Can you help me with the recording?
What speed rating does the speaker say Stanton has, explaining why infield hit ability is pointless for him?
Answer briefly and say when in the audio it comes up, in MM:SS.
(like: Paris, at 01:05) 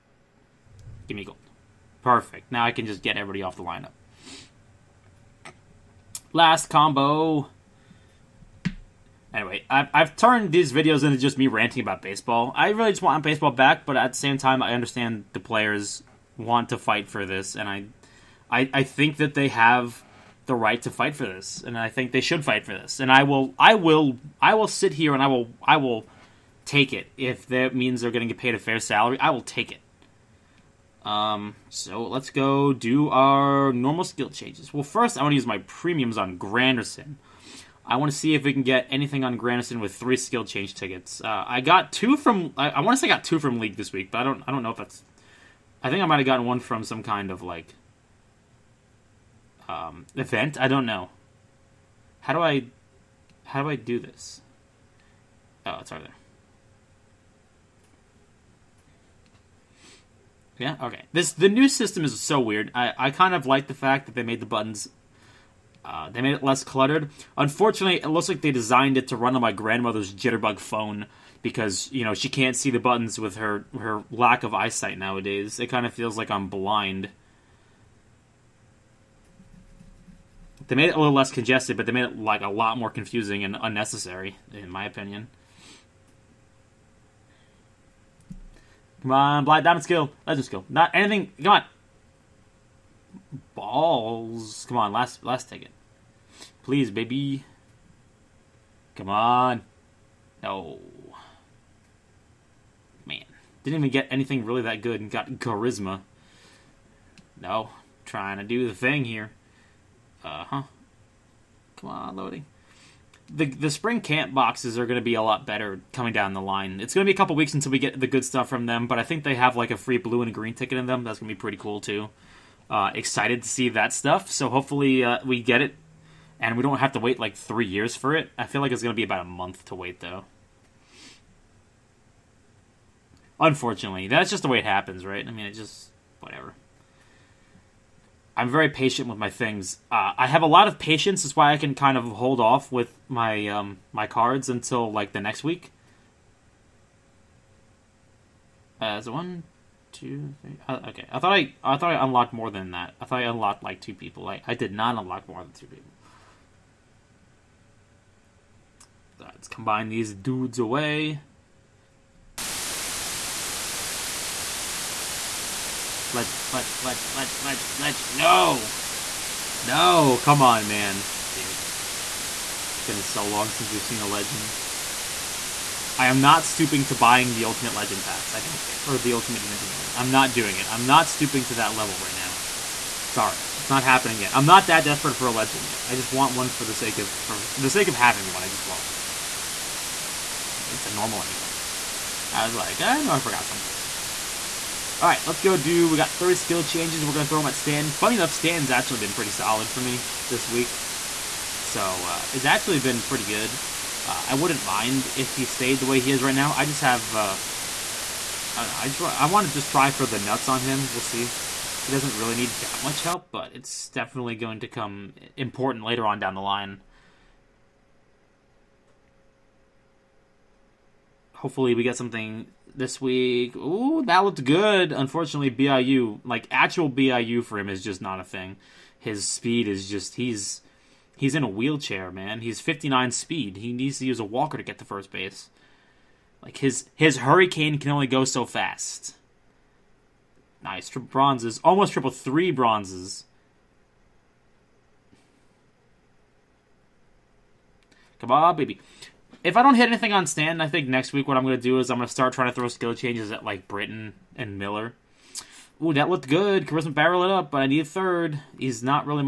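59, at 03:52.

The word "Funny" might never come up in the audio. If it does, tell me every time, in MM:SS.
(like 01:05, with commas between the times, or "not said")
03:17.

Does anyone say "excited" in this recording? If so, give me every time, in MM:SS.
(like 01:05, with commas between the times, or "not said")
02:02.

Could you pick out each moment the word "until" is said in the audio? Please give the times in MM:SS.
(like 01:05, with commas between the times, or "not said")
01:57, 02:24.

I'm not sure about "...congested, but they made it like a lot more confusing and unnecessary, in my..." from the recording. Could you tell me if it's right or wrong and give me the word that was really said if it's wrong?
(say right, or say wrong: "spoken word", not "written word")
right.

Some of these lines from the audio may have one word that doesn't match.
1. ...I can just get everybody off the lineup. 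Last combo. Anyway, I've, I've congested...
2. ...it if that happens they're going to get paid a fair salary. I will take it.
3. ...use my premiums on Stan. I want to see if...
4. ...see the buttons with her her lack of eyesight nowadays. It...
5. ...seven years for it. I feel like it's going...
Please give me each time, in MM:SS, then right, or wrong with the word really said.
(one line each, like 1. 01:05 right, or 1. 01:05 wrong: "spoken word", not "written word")
1. 00:02 wrong: "turned", not "congested"
2. 00:26 wrong: "means", not "happens"
3. 00:35 wrong: "Granderson", not "Stan"
4. 01:12 right
5. 02:07 wrong: "three", not "seven".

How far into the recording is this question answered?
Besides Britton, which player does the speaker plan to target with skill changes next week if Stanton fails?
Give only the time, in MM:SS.
04:14.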